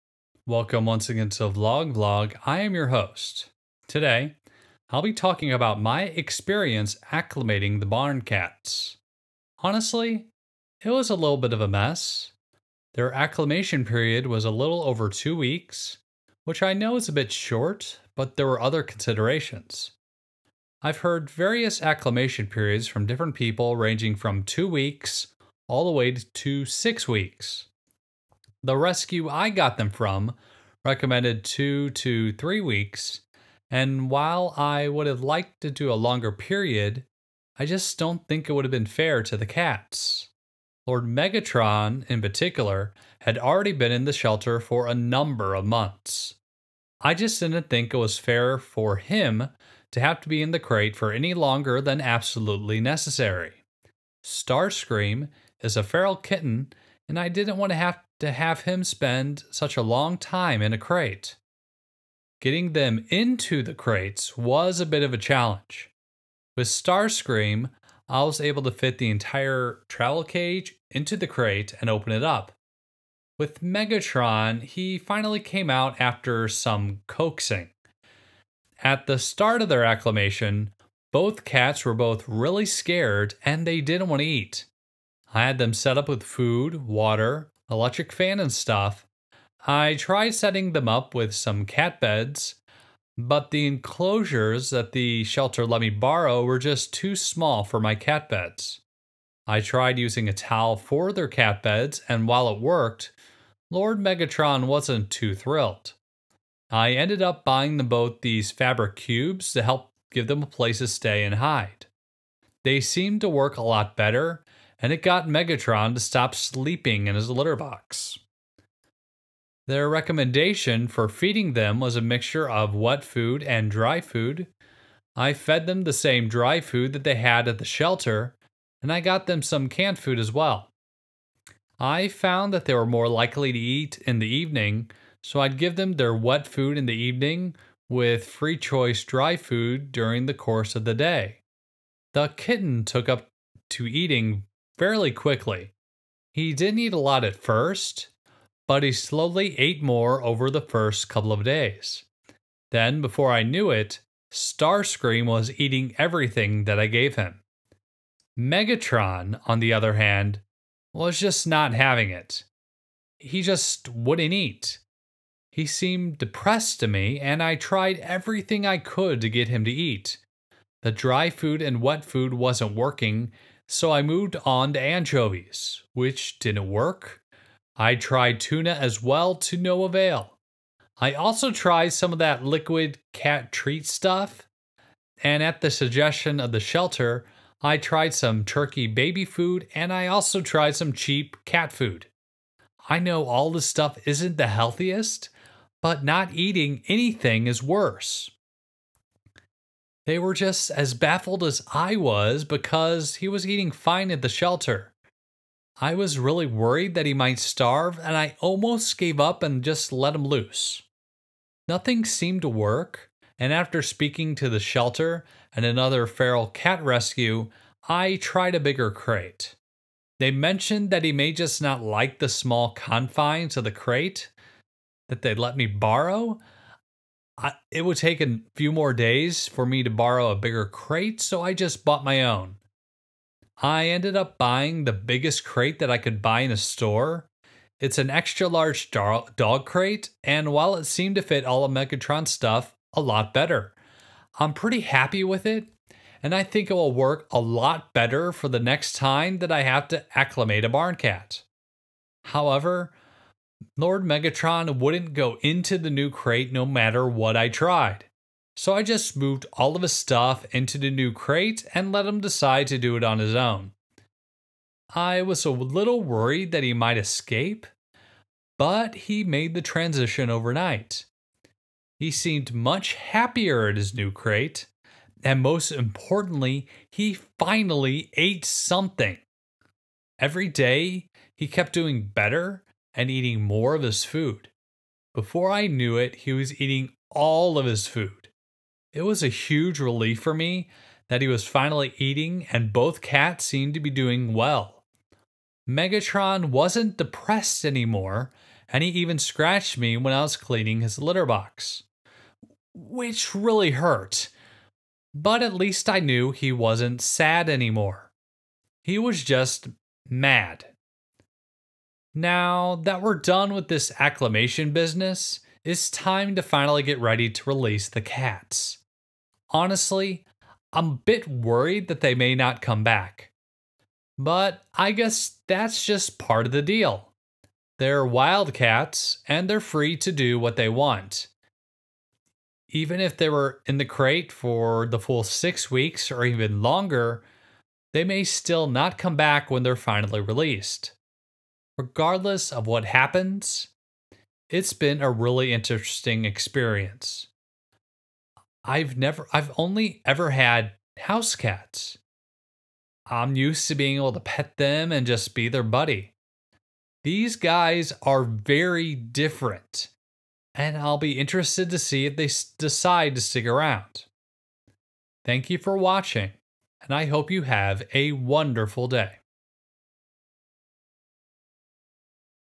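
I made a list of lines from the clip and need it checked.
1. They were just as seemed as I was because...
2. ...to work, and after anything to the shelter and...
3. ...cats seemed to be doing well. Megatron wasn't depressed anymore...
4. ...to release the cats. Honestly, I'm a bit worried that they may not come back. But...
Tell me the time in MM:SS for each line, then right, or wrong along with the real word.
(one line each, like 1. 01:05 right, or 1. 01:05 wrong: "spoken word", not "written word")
1. 03:20 wrong: "baffled", not "seemed"
2. 03:32 wrong: "speaking", not "anything"
3. 04:53 right
4. 05:17 right.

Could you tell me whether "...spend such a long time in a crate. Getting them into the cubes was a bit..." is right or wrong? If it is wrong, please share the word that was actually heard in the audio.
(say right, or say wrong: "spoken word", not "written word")
wrong: "crates", not "cubes".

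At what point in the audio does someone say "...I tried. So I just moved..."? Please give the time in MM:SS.
04:17.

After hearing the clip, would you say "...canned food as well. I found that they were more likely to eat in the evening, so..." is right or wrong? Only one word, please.
right.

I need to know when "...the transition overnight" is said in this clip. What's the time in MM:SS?
04:29.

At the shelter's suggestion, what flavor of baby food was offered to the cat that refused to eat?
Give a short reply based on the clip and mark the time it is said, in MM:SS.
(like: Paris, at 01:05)
turkey, at 03:08.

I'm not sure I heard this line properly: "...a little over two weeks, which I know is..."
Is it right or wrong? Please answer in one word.
right.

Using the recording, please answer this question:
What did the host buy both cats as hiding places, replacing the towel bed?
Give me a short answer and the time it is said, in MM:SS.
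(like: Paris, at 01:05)
fabric cubes, at 01:48.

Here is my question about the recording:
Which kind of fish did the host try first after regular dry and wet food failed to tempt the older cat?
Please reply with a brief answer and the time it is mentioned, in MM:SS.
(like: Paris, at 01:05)
anchovies, at 02:54.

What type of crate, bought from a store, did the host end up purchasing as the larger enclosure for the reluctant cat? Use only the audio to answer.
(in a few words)
extra large dog crate.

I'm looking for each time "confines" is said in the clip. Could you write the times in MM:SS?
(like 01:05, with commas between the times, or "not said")
03:42.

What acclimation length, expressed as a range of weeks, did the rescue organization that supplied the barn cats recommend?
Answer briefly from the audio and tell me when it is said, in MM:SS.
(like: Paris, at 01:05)
2 to 3 weeks, at 00:31.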